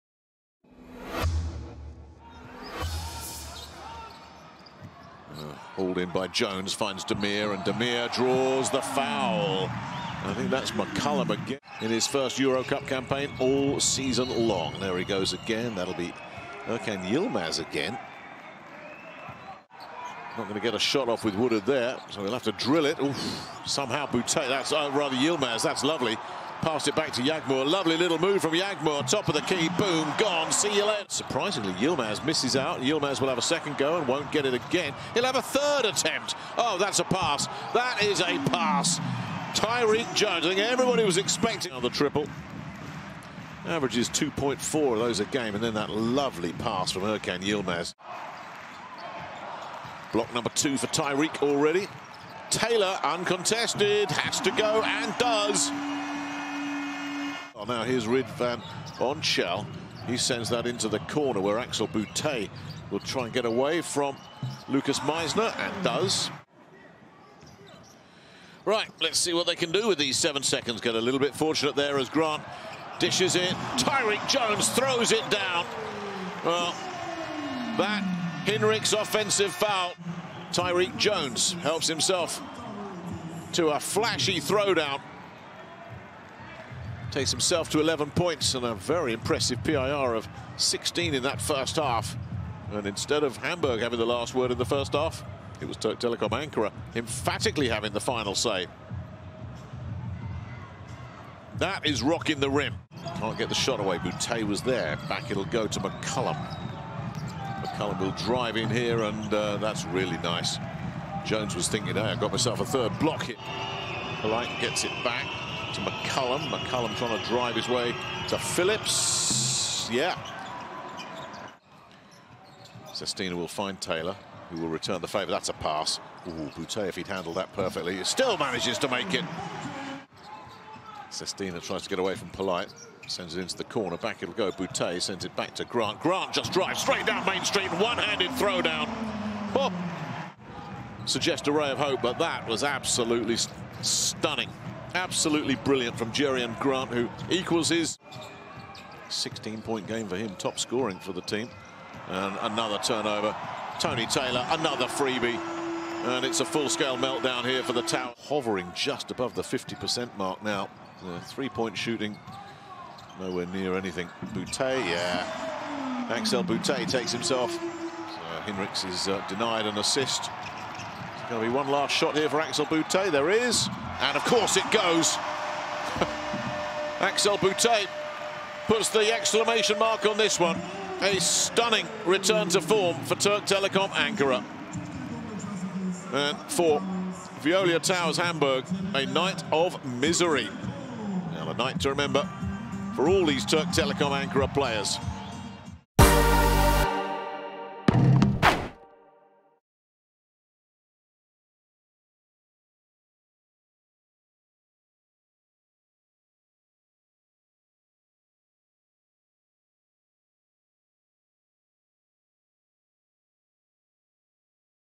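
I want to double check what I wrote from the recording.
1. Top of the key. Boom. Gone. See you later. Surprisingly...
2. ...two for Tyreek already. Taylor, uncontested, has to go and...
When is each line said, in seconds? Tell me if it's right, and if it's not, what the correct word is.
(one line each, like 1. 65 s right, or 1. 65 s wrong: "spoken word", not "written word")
1. 29 s right
2. 50 s right.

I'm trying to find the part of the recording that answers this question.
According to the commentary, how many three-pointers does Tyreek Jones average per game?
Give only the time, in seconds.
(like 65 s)
44 s.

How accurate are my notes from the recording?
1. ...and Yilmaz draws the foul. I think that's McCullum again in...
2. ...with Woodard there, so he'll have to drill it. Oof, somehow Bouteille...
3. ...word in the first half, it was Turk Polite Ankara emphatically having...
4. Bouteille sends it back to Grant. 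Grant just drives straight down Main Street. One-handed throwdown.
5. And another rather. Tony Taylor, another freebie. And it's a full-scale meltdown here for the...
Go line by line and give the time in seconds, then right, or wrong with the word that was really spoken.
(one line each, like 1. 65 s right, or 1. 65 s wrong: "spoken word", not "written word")
1. 7 s wrong: "Demir", not "Yilmaz"
2. 21 s right
3. 94 s wrong: "Telekom", not "Polite"
4. 134 s right
5. 152 s wrong: "turnover", not "rather".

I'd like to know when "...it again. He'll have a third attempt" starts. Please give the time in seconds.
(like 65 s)
34 s.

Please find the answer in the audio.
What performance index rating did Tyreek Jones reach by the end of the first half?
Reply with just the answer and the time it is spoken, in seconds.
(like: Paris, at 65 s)
16, at 90 s.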